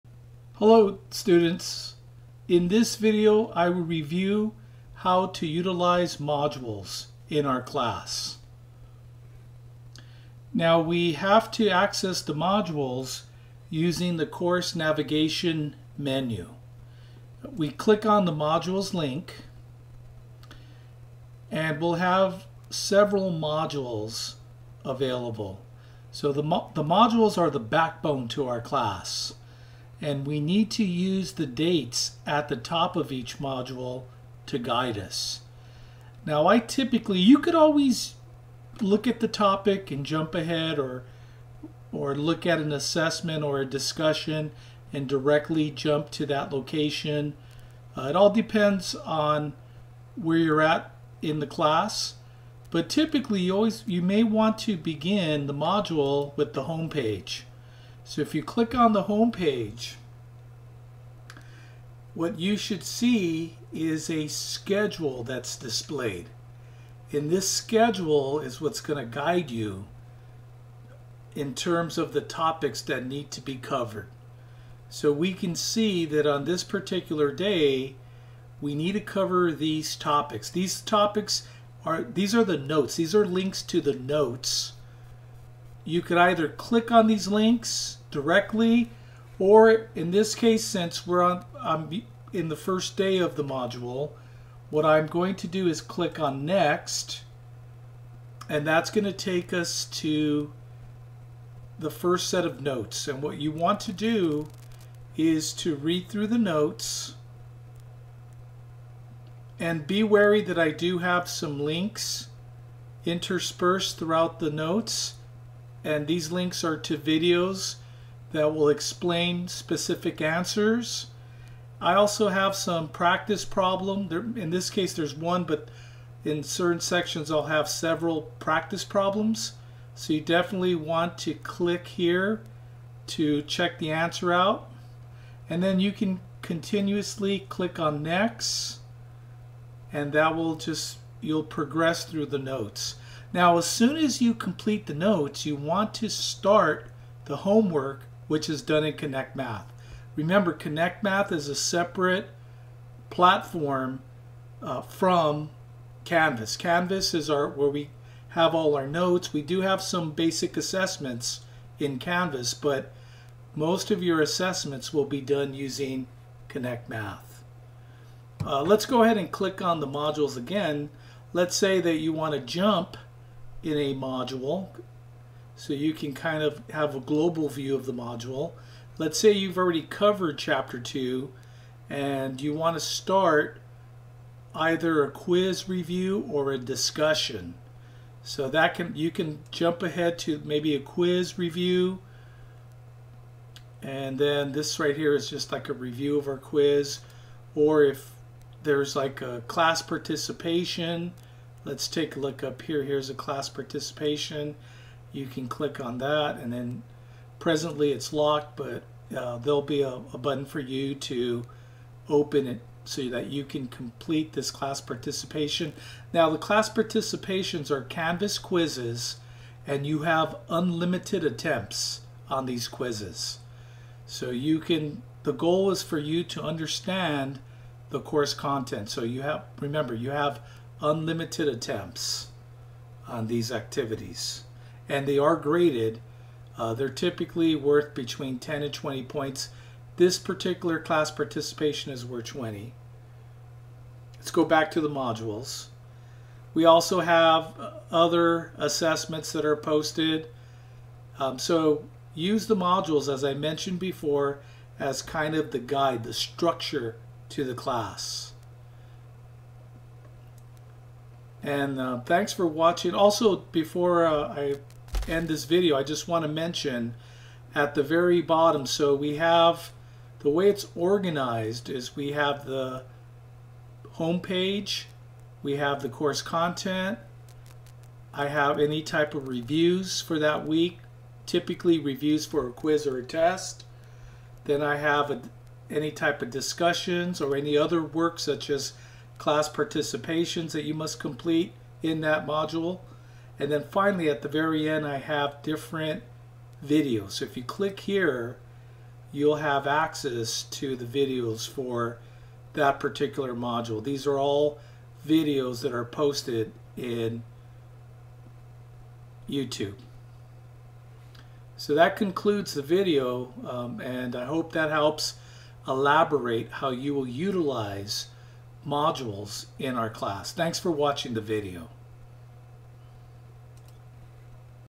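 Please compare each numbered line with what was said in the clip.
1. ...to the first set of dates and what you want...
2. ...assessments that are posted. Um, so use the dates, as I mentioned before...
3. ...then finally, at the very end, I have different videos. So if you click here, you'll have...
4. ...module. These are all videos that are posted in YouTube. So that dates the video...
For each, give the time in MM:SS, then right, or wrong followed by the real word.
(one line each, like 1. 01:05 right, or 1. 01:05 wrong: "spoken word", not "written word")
1. 01:39 wrong: "notes", not "dates"
2. 04:08 wrong: "modules", not "dates"
3. 04:53 right
4. 05:03 wrong: "concludes", not "dates".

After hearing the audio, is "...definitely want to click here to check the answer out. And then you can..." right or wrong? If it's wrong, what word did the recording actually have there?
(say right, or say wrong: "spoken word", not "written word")
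right.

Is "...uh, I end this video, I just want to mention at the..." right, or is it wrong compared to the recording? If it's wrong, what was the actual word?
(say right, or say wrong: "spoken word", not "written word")
right.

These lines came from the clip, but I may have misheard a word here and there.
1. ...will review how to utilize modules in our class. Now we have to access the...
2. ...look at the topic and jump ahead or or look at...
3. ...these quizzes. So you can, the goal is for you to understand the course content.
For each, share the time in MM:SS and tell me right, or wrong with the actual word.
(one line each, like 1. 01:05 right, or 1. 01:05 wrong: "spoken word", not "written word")
1. 00:03 right
2. 00:38 right
3. 03:42 right.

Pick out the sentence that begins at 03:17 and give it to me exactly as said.
Or if there's like a class participation, Let's take a look up here.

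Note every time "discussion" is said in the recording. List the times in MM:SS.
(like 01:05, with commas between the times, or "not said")
00:43, 03:06, 04:46.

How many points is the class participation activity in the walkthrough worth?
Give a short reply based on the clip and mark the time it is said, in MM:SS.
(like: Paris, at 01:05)
20, at 04:02.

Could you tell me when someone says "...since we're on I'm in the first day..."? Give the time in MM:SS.
01:30.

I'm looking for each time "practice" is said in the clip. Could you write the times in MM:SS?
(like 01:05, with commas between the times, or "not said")
02:02, 02:08.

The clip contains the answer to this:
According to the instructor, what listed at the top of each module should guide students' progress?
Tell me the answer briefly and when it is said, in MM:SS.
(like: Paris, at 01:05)
The dates, at 00:31.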